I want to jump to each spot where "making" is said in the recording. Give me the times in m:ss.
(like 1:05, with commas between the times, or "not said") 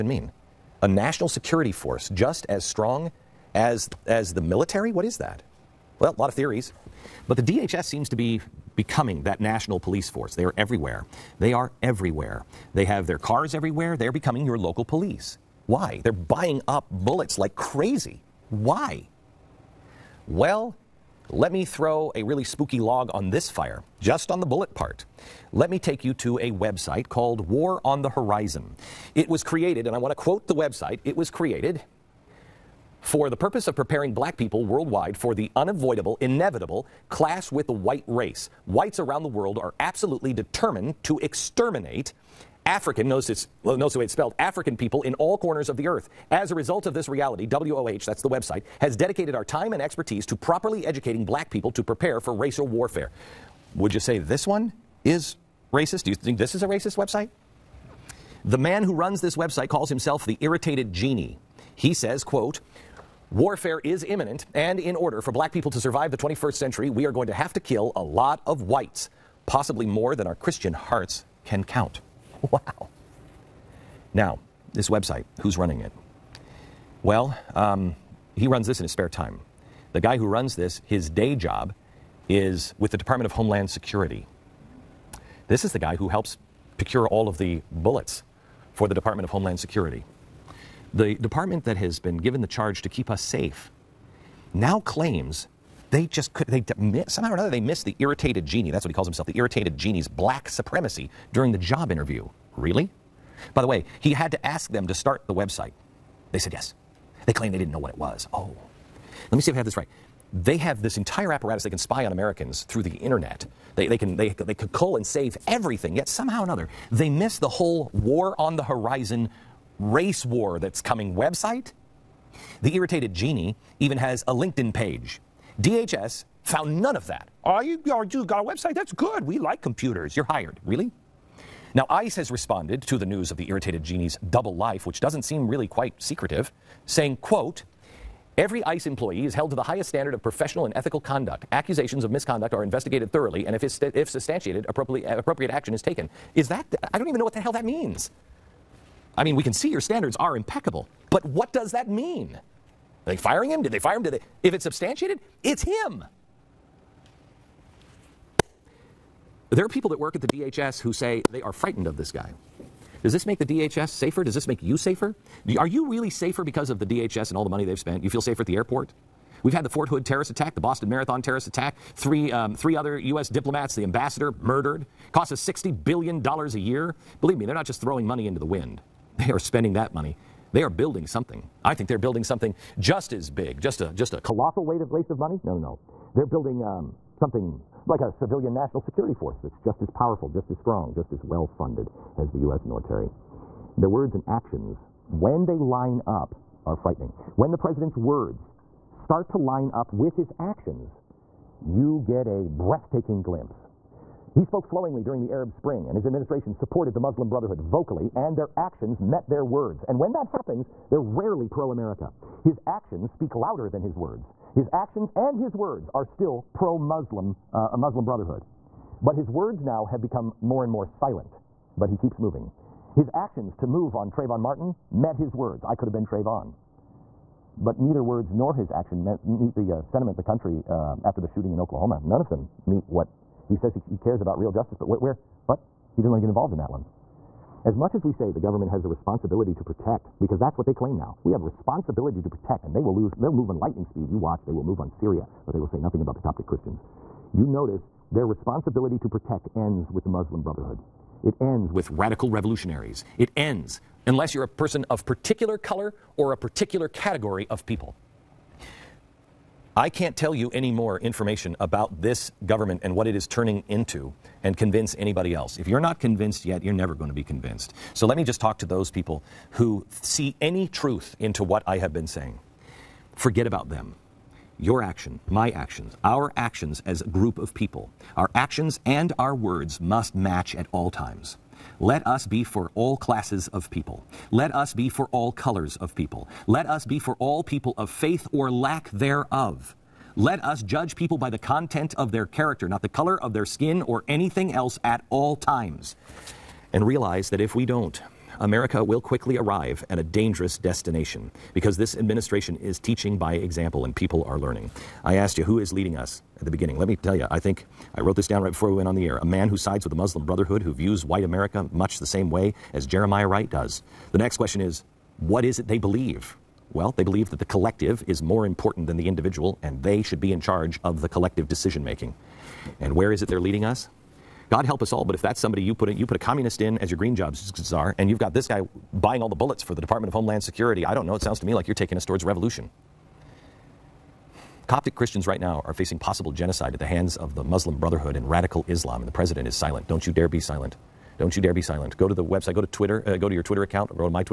5:21.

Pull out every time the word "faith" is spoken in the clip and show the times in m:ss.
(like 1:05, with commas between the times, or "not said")
4:47.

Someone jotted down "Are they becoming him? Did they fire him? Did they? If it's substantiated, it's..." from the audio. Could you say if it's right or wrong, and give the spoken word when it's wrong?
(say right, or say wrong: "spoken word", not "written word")
wrong: "firing", not "becoming".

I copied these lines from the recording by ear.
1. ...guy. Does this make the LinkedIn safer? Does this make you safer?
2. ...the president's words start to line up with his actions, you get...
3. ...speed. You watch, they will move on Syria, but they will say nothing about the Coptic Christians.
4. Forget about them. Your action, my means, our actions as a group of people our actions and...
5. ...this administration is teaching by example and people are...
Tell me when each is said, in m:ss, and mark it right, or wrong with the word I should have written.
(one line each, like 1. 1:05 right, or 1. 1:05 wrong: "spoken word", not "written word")
1. 2:42 wrong: "DHS", not "LinkedIn"
2. 3:17 right
3. 4:03 right
4. 4:33 wrong: "actions", not "means"
5. 5:01 right.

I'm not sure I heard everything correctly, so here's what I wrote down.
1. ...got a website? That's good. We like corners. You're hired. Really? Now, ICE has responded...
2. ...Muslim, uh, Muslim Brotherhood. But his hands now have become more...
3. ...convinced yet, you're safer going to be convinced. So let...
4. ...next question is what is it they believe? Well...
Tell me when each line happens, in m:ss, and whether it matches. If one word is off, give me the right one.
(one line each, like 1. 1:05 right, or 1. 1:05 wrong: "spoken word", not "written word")
1. 2:07 wrong: "computers", not "corners"
2. 3:36 wrong: "words", not "hands"
3. 4:25 wrong: "never", not "safer"
4. 5:14 right.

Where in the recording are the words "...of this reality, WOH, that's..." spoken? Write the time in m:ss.
0:46.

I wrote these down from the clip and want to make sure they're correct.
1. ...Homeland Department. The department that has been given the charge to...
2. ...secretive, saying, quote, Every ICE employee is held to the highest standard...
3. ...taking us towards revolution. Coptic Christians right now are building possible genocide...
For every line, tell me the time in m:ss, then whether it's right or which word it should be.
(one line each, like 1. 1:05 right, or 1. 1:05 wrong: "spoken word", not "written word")
1. 1:29 wrong: "Security", not "Department"
2. 2:15 right
3. 5:31 wrong: "facing", not "building".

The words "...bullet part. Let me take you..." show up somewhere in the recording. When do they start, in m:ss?
0:24.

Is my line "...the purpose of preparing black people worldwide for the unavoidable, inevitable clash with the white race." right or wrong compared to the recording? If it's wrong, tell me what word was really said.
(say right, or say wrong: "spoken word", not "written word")
right.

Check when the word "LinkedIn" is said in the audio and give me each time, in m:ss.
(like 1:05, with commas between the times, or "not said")
2:04.